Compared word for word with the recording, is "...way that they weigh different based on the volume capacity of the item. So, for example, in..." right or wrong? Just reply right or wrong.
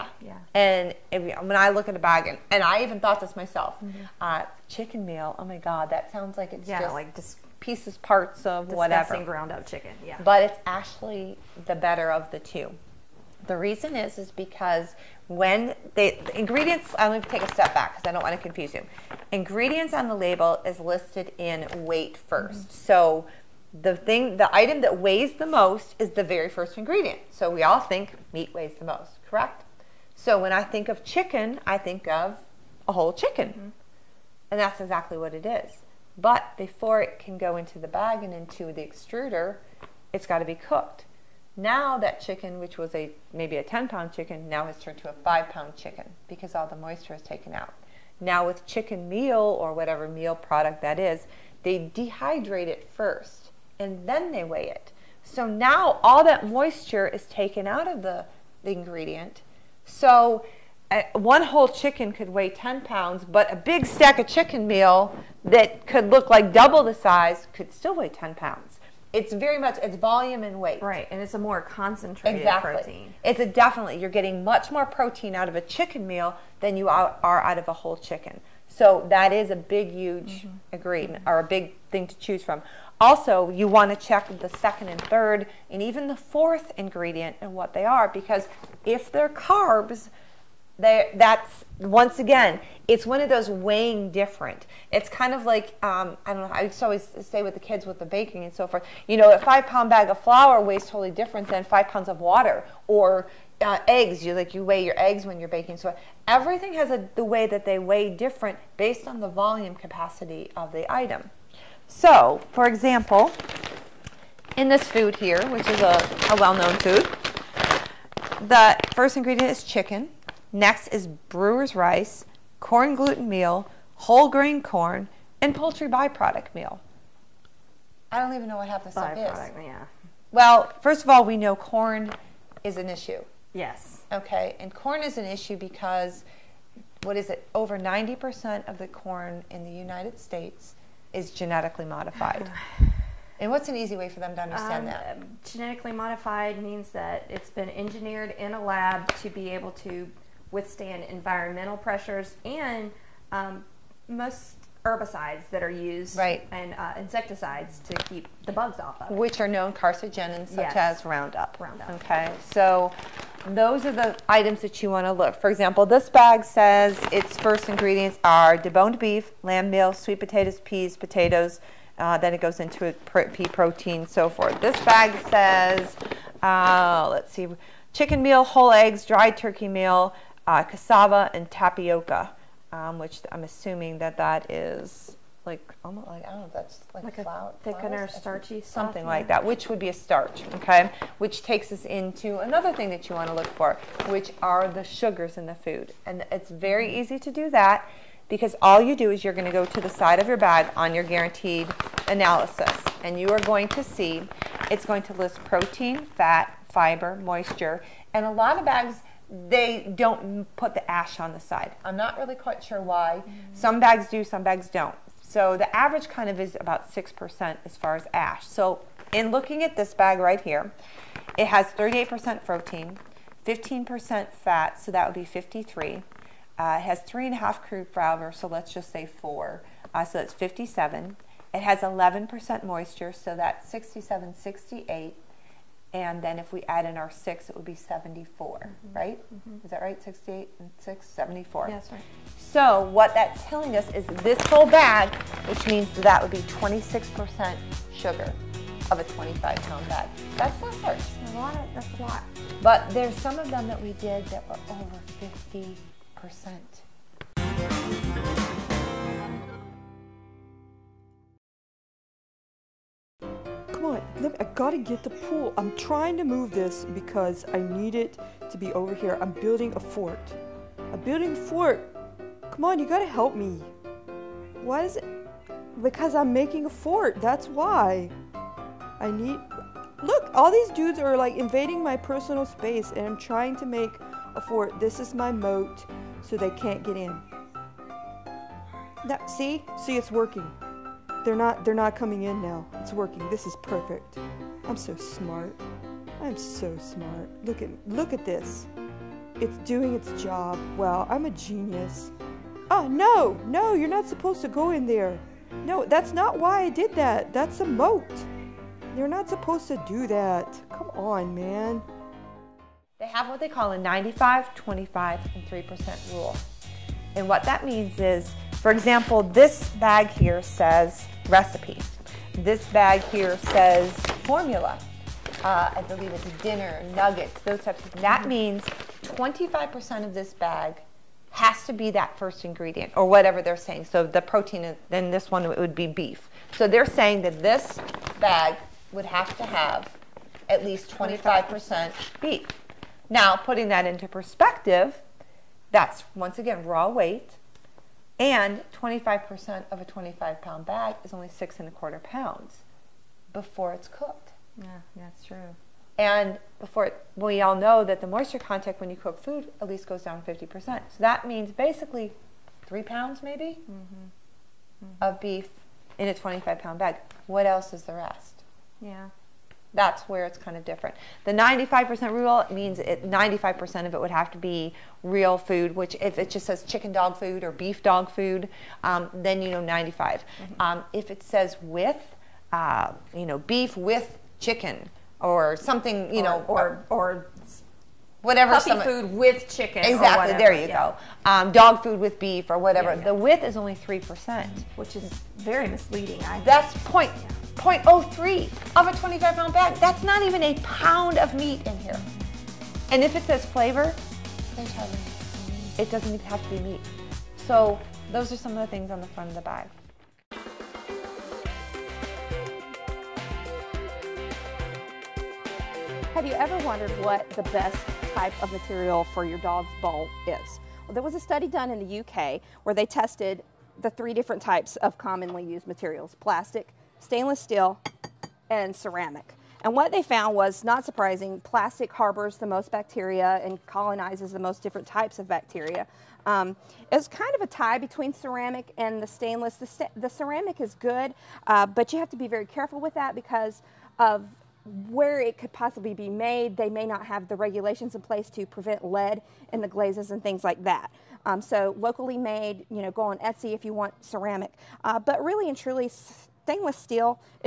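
right.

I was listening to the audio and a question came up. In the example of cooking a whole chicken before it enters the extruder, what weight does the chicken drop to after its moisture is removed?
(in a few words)
5 pounds.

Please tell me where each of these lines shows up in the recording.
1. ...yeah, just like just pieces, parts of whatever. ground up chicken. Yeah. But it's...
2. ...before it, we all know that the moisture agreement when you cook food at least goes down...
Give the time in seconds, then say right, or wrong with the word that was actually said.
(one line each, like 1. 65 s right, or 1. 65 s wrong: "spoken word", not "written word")
1. 6 s right
2. 356 s wrong: "content", not "agreement".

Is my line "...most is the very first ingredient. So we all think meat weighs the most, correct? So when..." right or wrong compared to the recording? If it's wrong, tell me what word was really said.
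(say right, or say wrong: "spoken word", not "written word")
right.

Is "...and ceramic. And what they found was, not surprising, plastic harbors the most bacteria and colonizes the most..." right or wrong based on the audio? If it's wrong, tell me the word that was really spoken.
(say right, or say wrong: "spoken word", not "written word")
right.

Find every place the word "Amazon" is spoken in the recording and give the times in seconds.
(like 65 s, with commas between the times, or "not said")
not said.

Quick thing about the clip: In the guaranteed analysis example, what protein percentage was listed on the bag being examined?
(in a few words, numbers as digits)
38%.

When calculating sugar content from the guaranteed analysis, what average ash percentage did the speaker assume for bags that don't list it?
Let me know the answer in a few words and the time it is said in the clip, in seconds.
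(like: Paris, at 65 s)
6%, at 216 s.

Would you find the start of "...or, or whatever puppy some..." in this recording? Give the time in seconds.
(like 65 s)
386 s.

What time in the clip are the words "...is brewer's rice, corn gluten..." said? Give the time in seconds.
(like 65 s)
120 s.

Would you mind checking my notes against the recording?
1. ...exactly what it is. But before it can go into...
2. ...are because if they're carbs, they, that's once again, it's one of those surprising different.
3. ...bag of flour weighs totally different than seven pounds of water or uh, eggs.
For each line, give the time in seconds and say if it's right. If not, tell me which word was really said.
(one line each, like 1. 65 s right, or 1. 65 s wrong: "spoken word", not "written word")
1. 34 s right
2. 87 s wrong: "weighing", not "surprising"
3. 99 s wrong: "five", not "seven".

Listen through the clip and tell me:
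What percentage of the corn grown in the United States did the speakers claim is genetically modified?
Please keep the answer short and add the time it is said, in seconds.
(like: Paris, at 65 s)
Over 90%, at 137 s.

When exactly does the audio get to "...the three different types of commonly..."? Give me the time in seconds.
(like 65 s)
423 s.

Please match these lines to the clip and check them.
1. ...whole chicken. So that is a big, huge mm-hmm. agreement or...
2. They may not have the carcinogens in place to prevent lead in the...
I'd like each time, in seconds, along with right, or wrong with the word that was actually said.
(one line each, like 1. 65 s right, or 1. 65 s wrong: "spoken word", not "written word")
1. 77 s right
2. 446 s wrong: "regulations", not "carcinogens".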